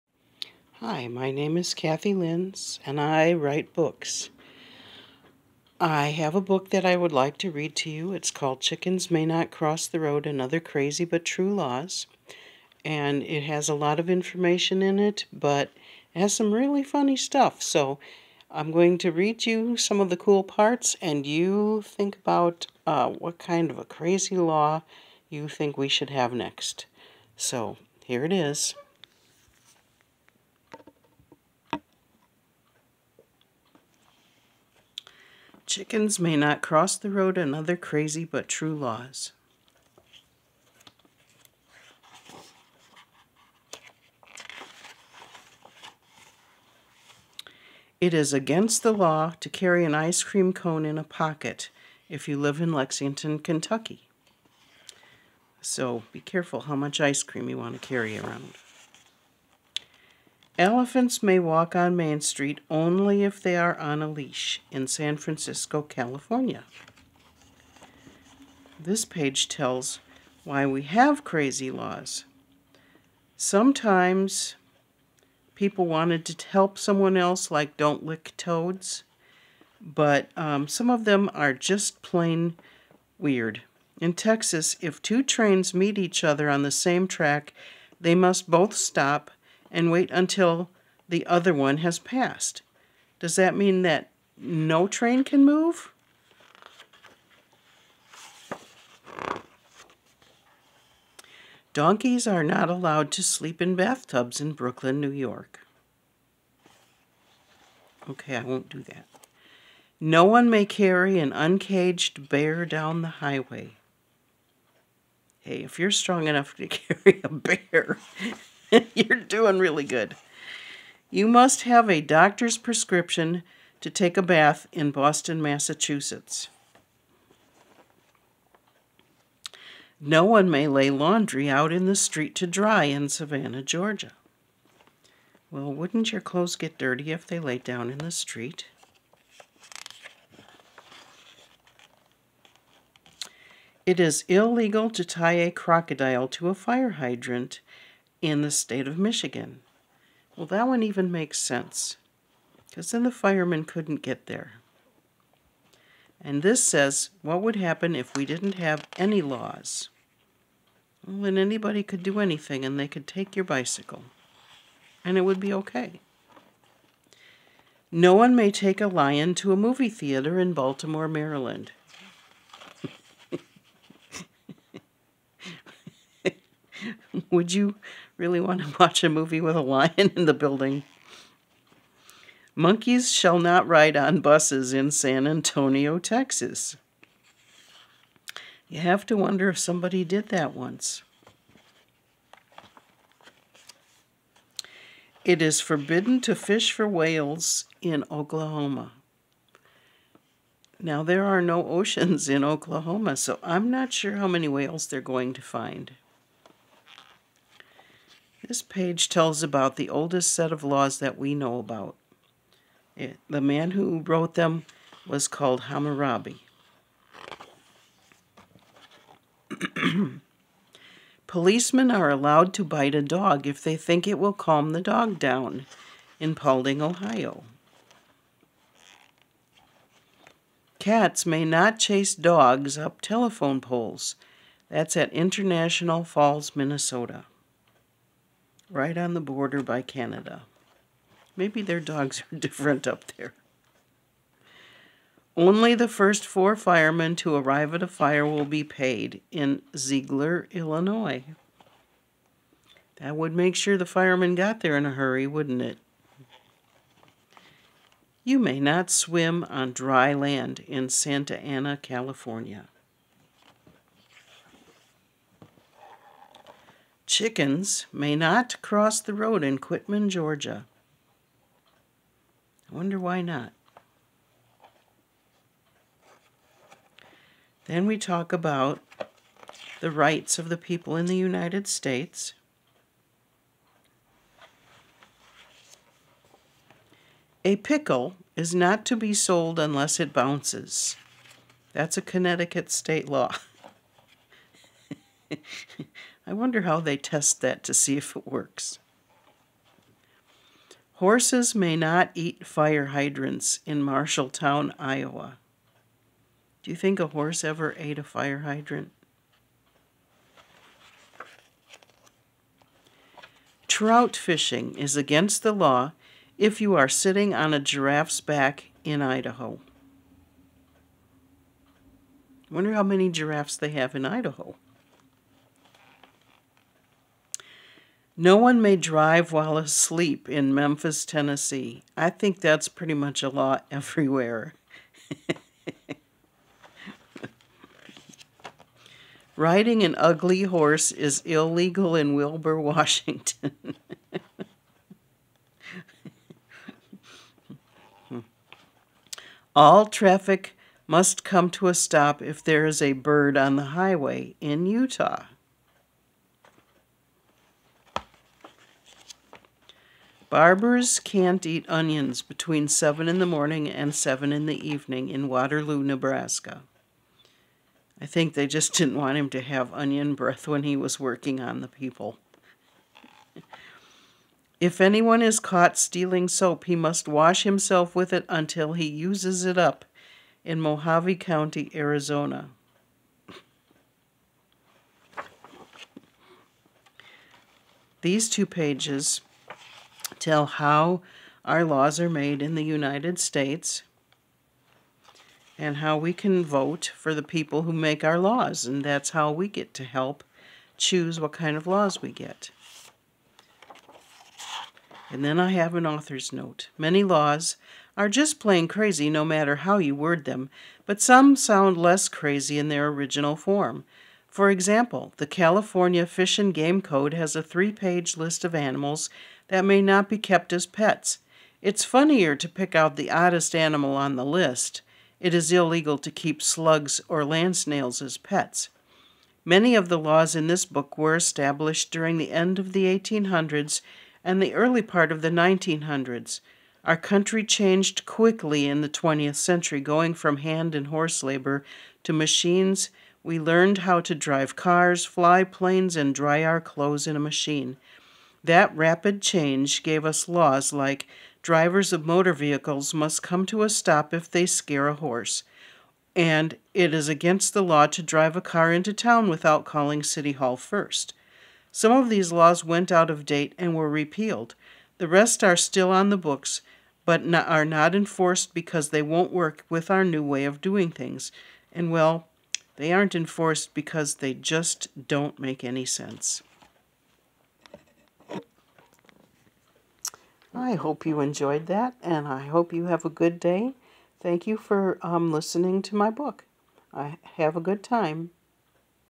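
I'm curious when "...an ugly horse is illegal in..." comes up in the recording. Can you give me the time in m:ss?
5:39.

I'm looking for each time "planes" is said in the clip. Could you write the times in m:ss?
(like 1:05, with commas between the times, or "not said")
7:25.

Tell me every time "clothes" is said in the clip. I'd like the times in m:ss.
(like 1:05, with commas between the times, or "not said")
2:16, 7:26.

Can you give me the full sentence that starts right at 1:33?
Does that mean that no train can move?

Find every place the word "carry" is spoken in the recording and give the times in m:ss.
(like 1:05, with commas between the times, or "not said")
0:49, 0:57, 1:50, 1:56.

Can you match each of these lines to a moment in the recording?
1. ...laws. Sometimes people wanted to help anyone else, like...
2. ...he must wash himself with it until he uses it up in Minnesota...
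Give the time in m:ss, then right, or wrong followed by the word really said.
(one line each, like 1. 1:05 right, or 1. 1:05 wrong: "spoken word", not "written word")
1. 1:11 wrong: "someone", not "anyone"
2. 6:16 wrong: "Mohave", not "Minnesota".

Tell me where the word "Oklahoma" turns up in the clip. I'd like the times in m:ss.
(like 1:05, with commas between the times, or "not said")
3:18, 3:22.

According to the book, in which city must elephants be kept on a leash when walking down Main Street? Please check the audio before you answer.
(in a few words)
San Francisco.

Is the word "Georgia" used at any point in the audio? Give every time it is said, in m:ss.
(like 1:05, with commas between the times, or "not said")
2:13, 4:30.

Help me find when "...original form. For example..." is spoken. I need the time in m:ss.
6:52.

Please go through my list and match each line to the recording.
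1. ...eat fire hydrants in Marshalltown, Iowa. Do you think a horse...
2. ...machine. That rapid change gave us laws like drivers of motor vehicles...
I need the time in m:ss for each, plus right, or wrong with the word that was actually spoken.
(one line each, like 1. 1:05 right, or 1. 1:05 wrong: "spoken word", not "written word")
1. 5:02 right
2. 7:27 right.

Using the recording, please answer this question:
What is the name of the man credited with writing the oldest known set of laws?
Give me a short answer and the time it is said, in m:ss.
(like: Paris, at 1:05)
Hammurabi, at 3:35.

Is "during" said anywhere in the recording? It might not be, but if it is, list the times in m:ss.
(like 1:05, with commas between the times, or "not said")
7:11.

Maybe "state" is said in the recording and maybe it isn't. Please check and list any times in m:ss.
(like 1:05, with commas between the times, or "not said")
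2:28, 4:41, 4:52, 6:33.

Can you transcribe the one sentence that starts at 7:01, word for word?
It's funnier to pick out the oddest animal on the list.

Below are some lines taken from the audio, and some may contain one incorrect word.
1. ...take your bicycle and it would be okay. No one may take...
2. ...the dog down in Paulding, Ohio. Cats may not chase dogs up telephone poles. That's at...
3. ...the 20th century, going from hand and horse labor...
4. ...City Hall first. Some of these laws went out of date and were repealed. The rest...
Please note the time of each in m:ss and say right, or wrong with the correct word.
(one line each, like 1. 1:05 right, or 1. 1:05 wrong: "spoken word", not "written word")
1. 2:43 right
2. 3:44 right
3. 7:18 right
4. 7:40 right.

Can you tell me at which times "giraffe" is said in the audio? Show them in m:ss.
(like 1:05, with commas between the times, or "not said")
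5:17, 5:23.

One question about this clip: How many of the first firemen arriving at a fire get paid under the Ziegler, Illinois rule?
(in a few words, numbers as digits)
4.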